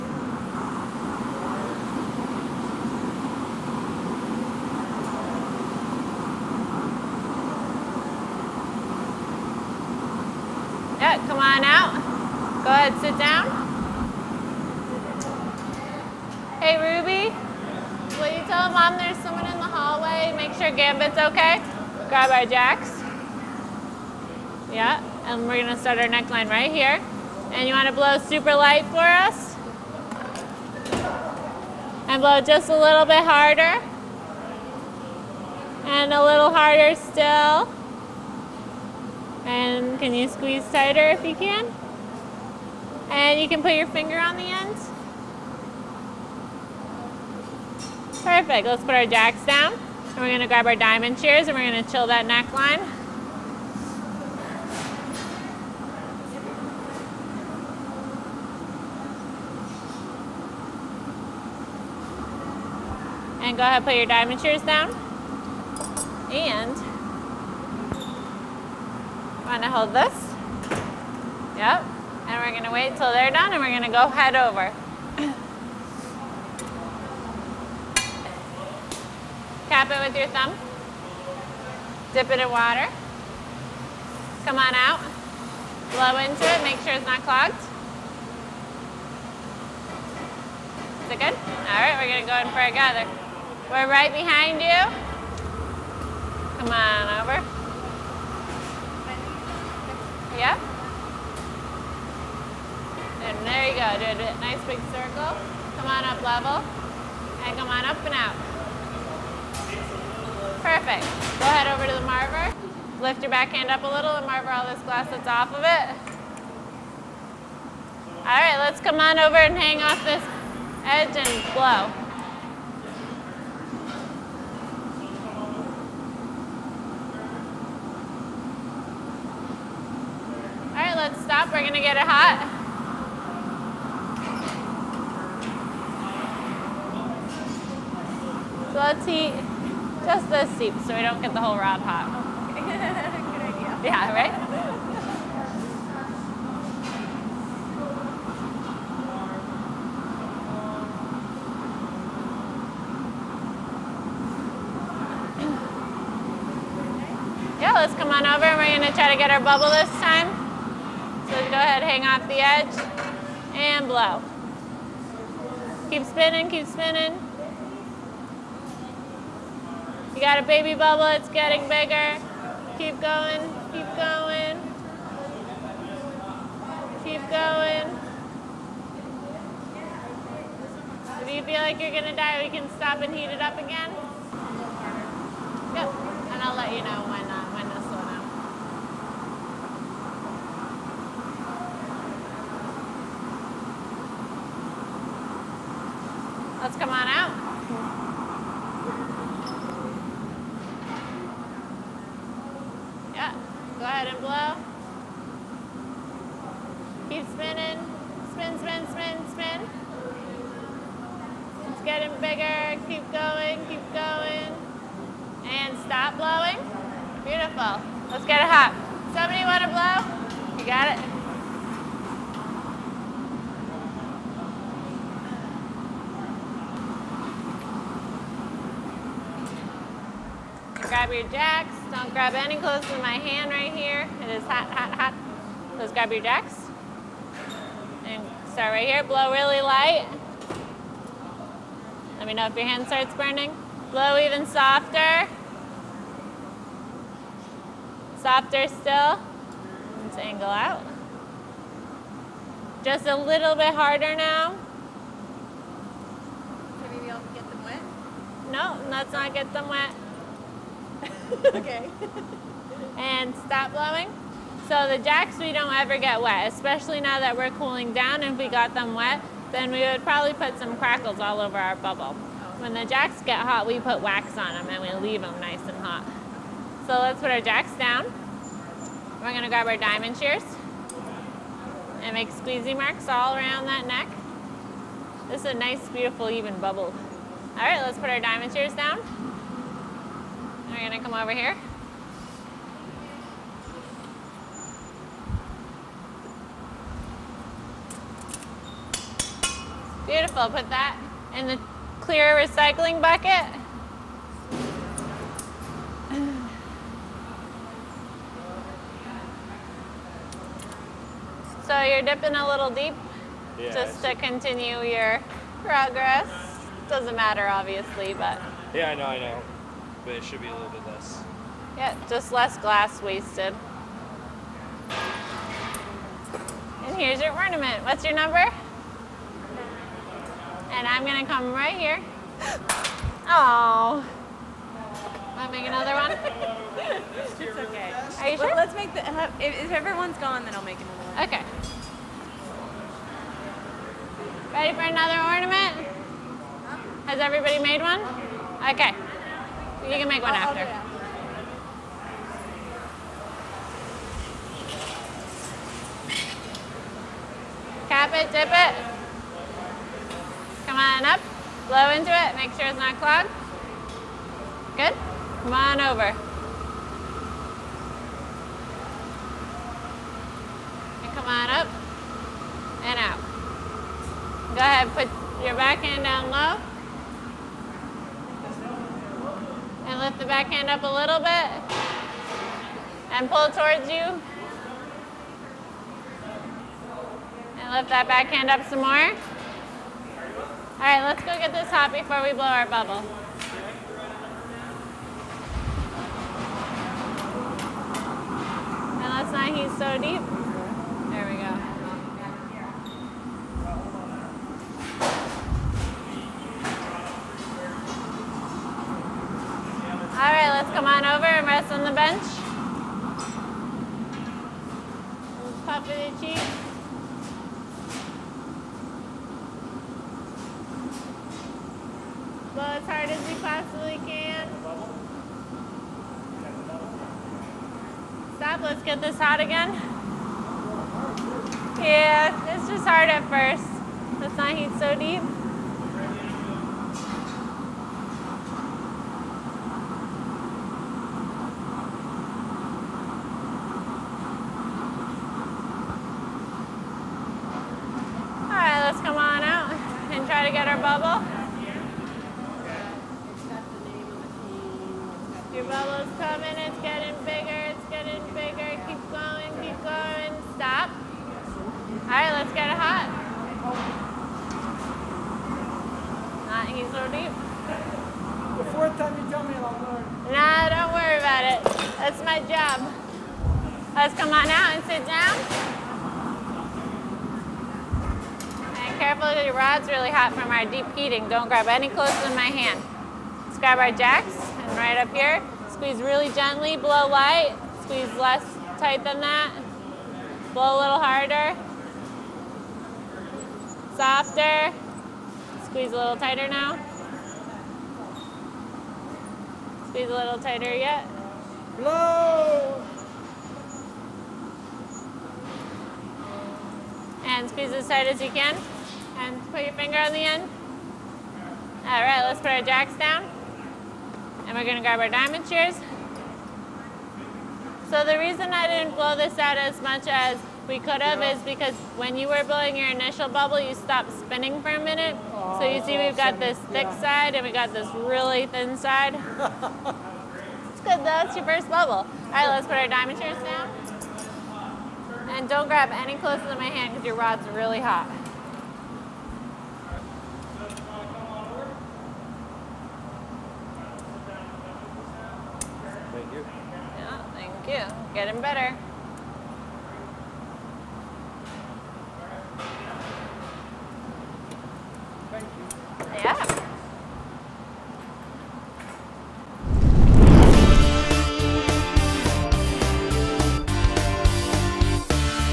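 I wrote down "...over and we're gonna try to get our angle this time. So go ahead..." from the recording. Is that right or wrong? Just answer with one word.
wrong.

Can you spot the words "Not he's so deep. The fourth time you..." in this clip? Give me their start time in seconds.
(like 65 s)
466 s.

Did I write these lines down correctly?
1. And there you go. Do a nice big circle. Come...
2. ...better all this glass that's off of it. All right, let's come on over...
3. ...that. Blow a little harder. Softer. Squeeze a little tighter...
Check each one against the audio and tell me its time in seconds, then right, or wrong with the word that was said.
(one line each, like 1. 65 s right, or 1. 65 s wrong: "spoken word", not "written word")
1. 103 s right
2. 114 s wrong: "marver", not "better"
3. 489 s right.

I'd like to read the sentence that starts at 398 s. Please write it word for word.
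And let's not heat so deep.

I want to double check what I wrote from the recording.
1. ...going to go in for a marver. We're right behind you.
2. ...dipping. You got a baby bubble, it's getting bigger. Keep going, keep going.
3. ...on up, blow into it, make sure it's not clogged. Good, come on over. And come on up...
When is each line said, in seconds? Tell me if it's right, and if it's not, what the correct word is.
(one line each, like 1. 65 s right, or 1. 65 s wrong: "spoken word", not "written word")
1. 92 s wrong: "gather", not "marver"
2. 166 s wrong: "spinning", not "dipping"
3. 360 s right.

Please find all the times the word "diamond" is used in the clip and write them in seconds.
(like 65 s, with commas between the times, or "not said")
50 s, 64 s, 279 s, 288 s, 515 s, 532 s.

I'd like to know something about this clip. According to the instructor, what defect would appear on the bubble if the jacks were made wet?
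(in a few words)
Crackles.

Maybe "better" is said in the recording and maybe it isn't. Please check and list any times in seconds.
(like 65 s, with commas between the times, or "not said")
548 s.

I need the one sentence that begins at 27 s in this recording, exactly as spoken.
And you wanna blow super light for us?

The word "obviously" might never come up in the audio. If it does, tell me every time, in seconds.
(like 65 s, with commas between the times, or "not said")
317 s.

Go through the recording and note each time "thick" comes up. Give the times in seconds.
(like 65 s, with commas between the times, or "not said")
526 s.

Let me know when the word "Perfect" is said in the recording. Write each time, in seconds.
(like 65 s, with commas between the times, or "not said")
48 s, 110 s.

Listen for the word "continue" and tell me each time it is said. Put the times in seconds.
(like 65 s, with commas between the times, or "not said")
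314 s.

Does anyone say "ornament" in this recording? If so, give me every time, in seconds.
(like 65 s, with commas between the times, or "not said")
327 s, 345 s.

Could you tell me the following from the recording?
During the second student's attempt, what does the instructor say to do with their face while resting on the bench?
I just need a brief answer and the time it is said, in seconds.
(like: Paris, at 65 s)
Pop cheeks, at 415 s.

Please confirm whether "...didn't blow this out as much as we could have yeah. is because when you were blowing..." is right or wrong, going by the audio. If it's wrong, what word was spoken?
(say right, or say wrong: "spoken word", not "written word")
right.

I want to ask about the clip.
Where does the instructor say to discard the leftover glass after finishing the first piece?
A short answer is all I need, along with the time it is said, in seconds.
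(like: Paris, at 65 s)
Clear recycling bucket, at 302 s.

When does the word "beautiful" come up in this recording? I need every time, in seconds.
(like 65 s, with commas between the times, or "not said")
217 s, 285 s, 300 s.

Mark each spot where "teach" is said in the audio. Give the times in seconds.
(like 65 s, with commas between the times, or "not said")
not said.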